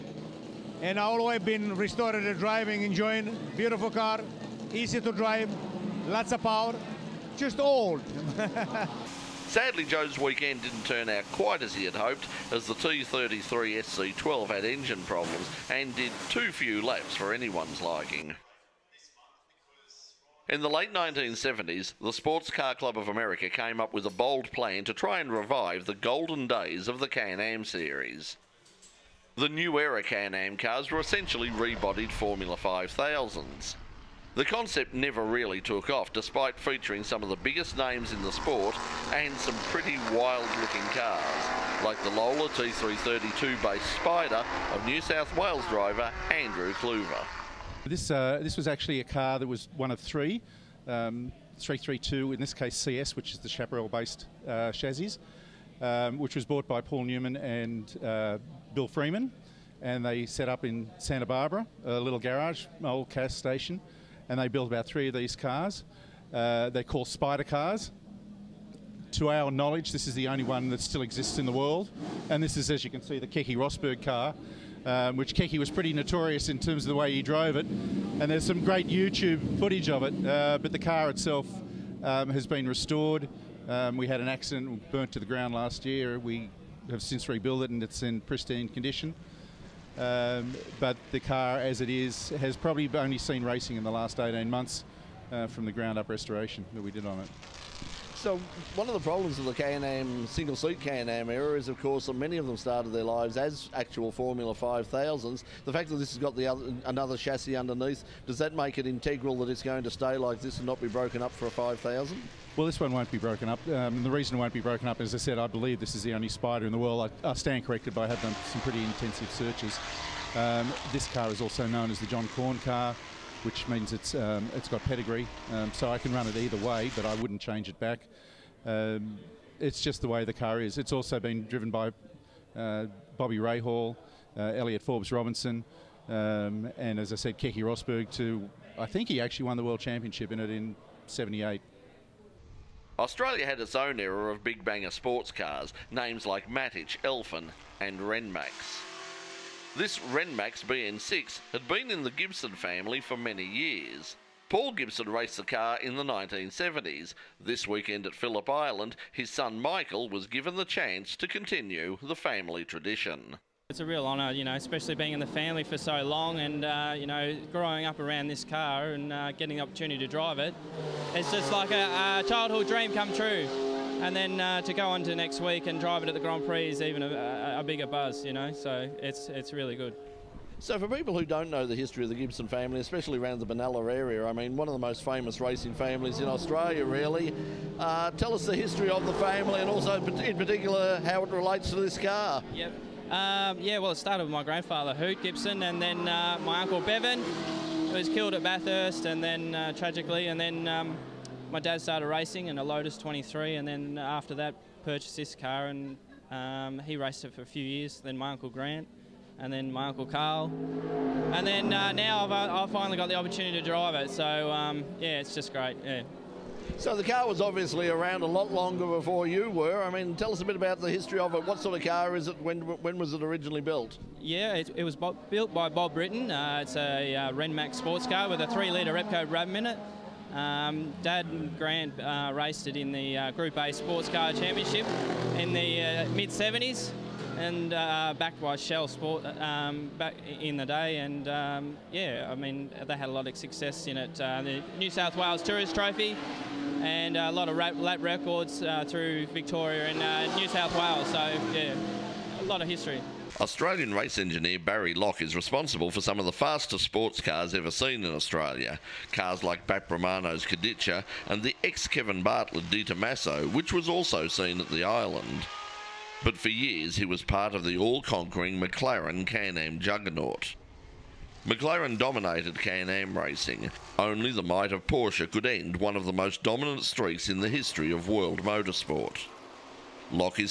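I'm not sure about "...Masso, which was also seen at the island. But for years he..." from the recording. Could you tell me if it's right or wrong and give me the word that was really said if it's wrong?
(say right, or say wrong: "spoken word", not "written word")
right.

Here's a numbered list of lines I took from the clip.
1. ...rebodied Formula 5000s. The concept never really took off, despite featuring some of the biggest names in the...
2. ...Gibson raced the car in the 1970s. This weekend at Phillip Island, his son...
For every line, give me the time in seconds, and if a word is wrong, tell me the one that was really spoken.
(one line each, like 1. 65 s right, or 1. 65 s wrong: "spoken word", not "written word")
1. 31 s right
2. 154 s right.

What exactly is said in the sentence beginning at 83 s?
Um, we had an accident, burnt to the ground last year.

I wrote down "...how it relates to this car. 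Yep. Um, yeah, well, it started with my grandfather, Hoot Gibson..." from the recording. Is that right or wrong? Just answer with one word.
right.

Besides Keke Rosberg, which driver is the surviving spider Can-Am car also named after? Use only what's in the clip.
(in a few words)
John Corn.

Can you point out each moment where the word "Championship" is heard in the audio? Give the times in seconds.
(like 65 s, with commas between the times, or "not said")
139 s, 234 s.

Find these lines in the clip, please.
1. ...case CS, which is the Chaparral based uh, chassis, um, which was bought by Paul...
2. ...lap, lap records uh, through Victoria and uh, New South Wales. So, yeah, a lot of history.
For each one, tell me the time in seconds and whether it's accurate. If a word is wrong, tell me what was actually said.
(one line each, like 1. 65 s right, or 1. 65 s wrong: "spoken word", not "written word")
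1. 52 s right
2. 247 s right.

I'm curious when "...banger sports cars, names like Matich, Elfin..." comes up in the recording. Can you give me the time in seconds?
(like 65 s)
144 s.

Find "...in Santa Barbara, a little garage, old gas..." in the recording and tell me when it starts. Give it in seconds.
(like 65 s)
60 s.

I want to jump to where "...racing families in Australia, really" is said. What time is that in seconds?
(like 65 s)
185 s.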